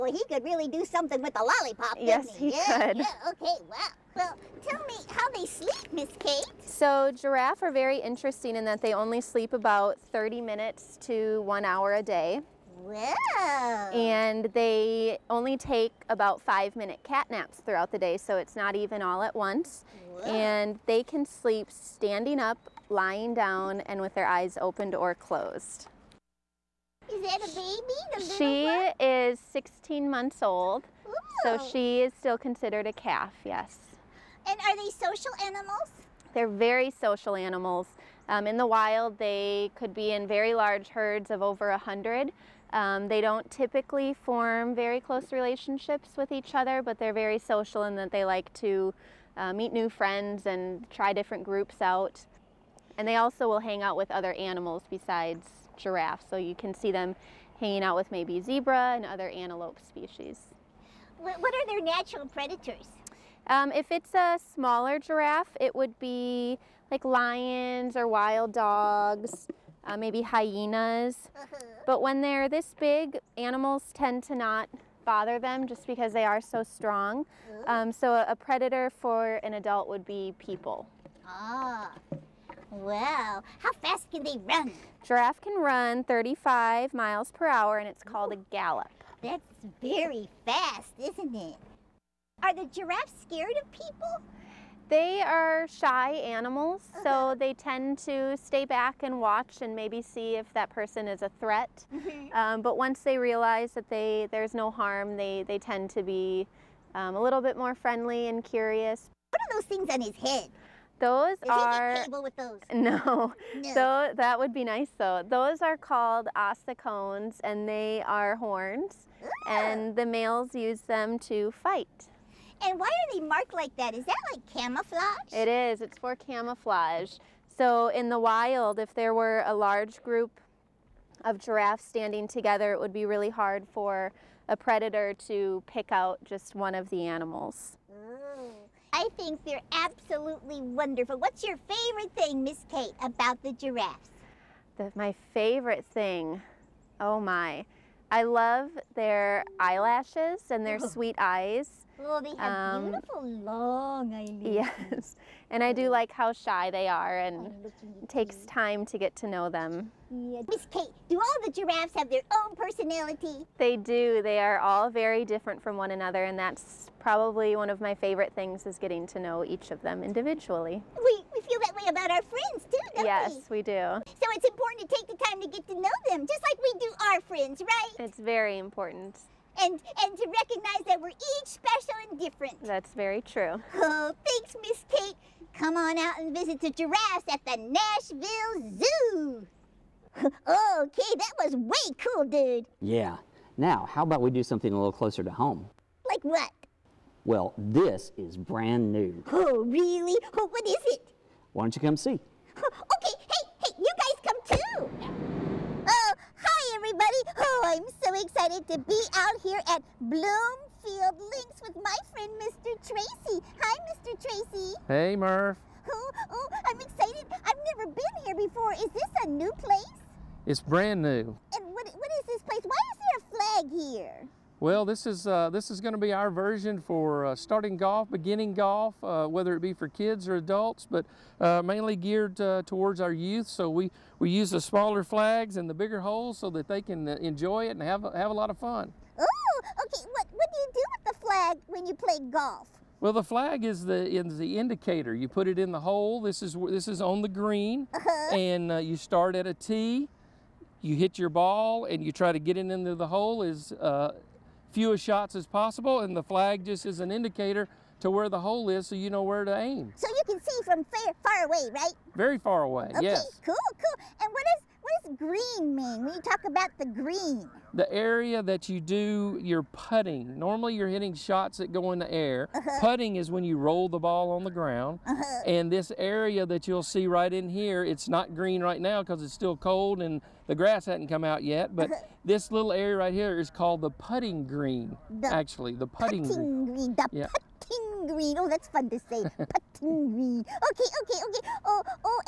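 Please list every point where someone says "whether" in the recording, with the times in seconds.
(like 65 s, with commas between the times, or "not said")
229 s.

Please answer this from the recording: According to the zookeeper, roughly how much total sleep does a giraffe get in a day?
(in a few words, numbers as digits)
30 minutes to 1 hour.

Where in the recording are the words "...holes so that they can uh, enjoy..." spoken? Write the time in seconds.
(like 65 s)
236 s.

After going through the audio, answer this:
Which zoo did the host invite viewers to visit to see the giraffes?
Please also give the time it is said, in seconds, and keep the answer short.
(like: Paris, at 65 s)
Nashville Zoo, at 187 s.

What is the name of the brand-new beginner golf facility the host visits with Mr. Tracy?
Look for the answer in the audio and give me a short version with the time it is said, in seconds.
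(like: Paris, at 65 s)
Bloomfield Links, at 210 s.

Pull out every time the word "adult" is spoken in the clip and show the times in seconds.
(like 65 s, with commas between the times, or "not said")
79 s, 230 s.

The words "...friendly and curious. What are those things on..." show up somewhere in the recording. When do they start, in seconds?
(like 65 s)
107 s.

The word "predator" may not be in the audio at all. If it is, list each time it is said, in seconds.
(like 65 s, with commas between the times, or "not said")
62 s, 78 s, 134 s.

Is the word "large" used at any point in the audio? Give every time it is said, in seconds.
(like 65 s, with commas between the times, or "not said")
40 s, 129 s.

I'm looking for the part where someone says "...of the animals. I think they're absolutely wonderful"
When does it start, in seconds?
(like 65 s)
136 s.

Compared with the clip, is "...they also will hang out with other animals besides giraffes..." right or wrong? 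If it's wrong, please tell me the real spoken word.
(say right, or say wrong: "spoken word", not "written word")
right.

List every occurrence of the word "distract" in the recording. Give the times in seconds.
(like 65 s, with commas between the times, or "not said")
not said.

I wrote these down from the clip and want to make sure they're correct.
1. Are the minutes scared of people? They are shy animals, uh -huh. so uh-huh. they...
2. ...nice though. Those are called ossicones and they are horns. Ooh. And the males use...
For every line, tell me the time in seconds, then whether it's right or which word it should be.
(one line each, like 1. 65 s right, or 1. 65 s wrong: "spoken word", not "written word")
1. 92 s wrong: "giraffes", not "minutes"
2. 114 s right.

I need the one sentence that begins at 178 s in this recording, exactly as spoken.
It's very important and, and to recognize that we're each special and different.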